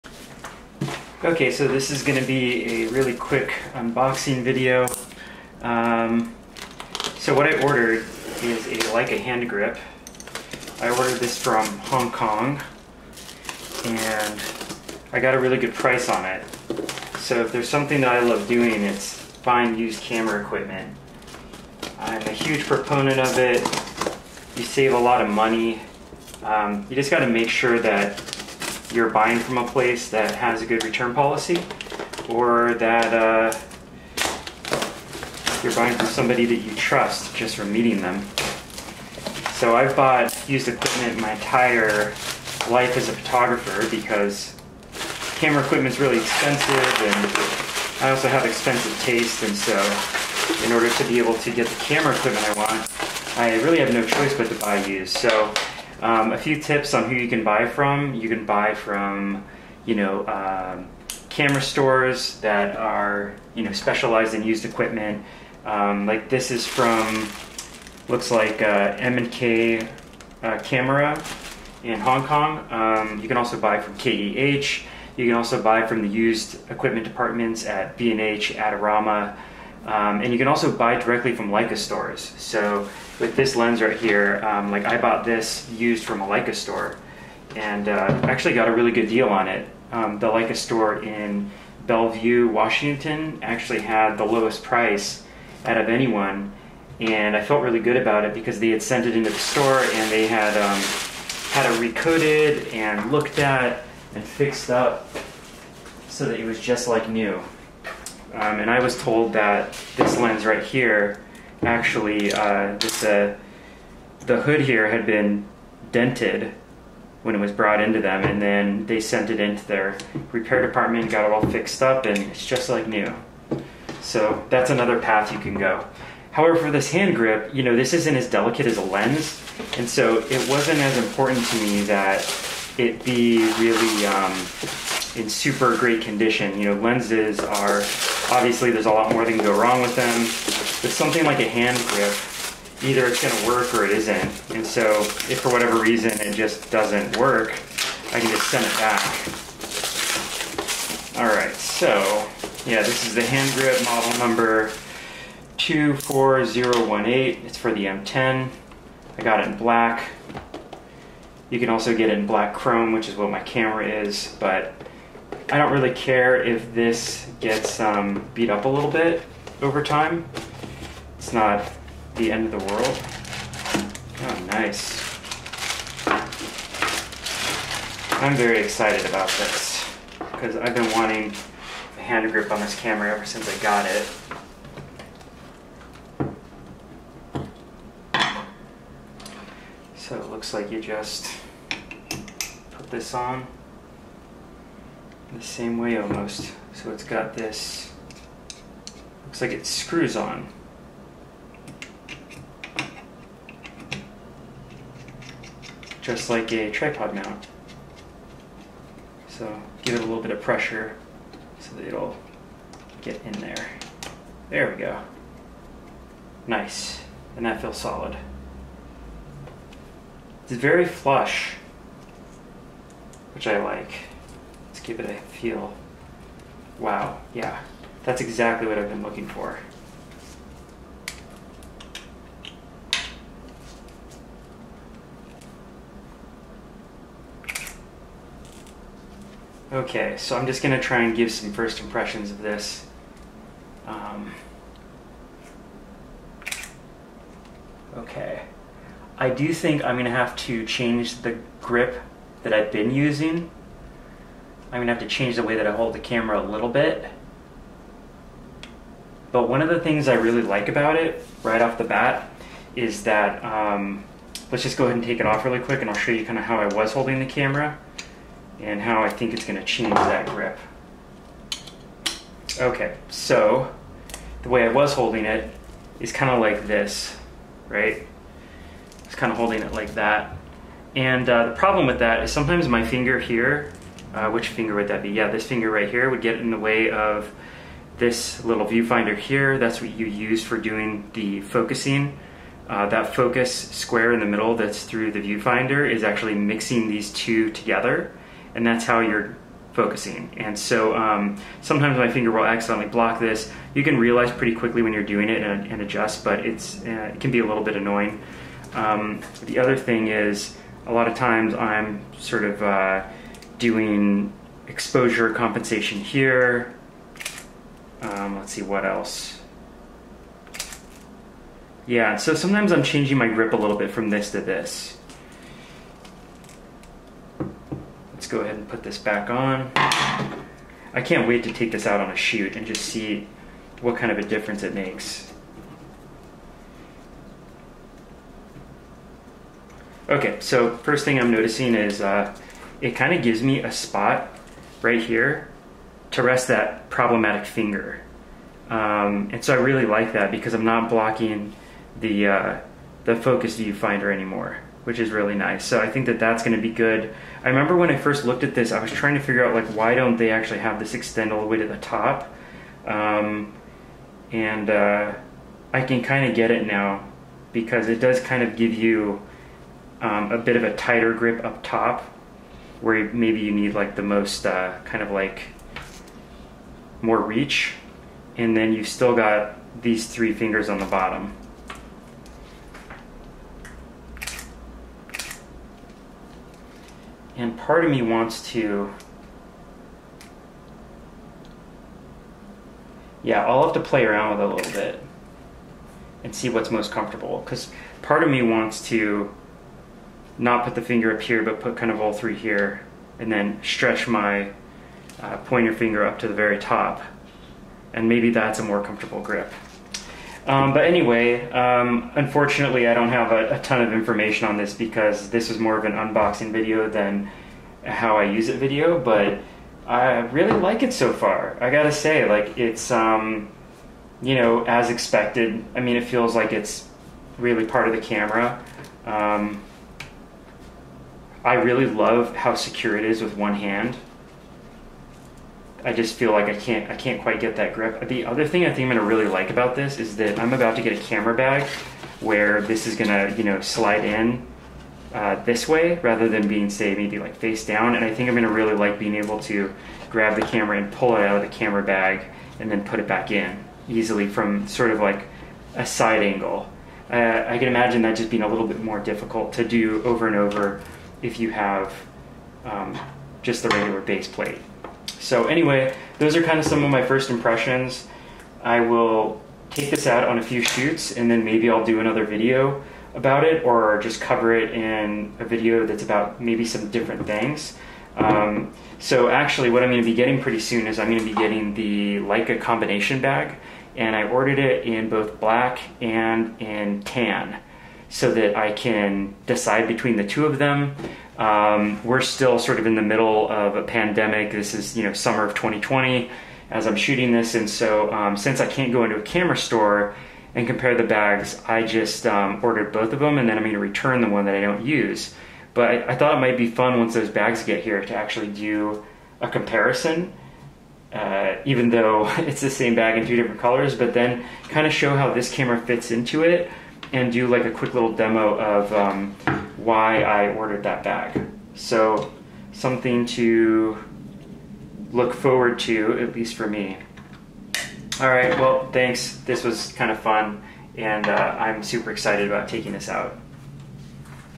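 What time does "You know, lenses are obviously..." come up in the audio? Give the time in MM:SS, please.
02:16.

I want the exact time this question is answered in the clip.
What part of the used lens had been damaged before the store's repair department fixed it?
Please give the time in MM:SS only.
01:54.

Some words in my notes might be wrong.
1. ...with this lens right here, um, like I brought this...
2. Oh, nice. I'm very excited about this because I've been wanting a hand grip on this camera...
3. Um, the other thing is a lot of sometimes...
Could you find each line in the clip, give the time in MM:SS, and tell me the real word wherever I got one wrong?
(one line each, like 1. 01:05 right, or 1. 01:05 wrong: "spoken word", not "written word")
1. 01:23 wrong: "bought", not "brought"
2. 02:54 right
3. 05:08 wrong: "times", not "sometimes".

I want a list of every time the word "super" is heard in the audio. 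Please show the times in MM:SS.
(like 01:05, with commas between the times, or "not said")
02:15, 08:51.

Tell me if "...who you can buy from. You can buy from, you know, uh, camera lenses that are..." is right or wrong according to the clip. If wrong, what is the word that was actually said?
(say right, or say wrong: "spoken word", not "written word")
wrong: "stores", not "lenses".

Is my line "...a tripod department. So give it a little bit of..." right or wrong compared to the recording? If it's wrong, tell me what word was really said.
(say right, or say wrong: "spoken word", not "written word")
wrong: "mount", not "department".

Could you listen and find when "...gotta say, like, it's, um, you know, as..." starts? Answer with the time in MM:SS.
07:01.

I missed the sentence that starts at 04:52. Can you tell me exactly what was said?
Uh, that focus square in the middle that's through the viewfinder is actually mixing these two together, and that's how you're focusing.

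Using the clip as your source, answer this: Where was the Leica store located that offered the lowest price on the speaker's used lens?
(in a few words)
Bellevue, Washington.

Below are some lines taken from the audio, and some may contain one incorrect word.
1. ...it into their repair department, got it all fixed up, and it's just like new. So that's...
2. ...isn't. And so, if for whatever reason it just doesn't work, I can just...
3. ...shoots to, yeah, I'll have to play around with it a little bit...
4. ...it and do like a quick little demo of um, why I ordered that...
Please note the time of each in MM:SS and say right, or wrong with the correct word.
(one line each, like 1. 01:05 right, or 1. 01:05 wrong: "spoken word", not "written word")
1. 01:59 right
2. 02:23 right
3. 06:28 wrong: "wants", not "shoots"
4. 08:36 right.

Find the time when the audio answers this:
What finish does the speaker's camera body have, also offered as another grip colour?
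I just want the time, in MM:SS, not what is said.
02:42.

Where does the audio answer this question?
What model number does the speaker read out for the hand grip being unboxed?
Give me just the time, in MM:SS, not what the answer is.
02:35.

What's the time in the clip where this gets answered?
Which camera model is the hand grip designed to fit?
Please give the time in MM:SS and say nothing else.
02:37.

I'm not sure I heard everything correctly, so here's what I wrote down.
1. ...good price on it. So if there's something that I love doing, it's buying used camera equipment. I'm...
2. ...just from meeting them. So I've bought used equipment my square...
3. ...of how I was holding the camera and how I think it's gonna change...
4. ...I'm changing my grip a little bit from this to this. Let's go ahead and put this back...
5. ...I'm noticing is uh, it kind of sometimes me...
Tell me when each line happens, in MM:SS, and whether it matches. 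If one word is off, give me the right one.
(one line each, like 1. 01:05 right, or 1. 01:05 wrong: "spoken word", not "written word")
1. 00:15 right
2. 00:37 wrong: "entire", not "square"
3. 04:26 right
4. 05:22 right
5. 05:41 wrong: "gives", not "sometimes".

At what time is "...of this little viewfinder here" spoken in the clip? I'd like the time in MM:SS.
04:46.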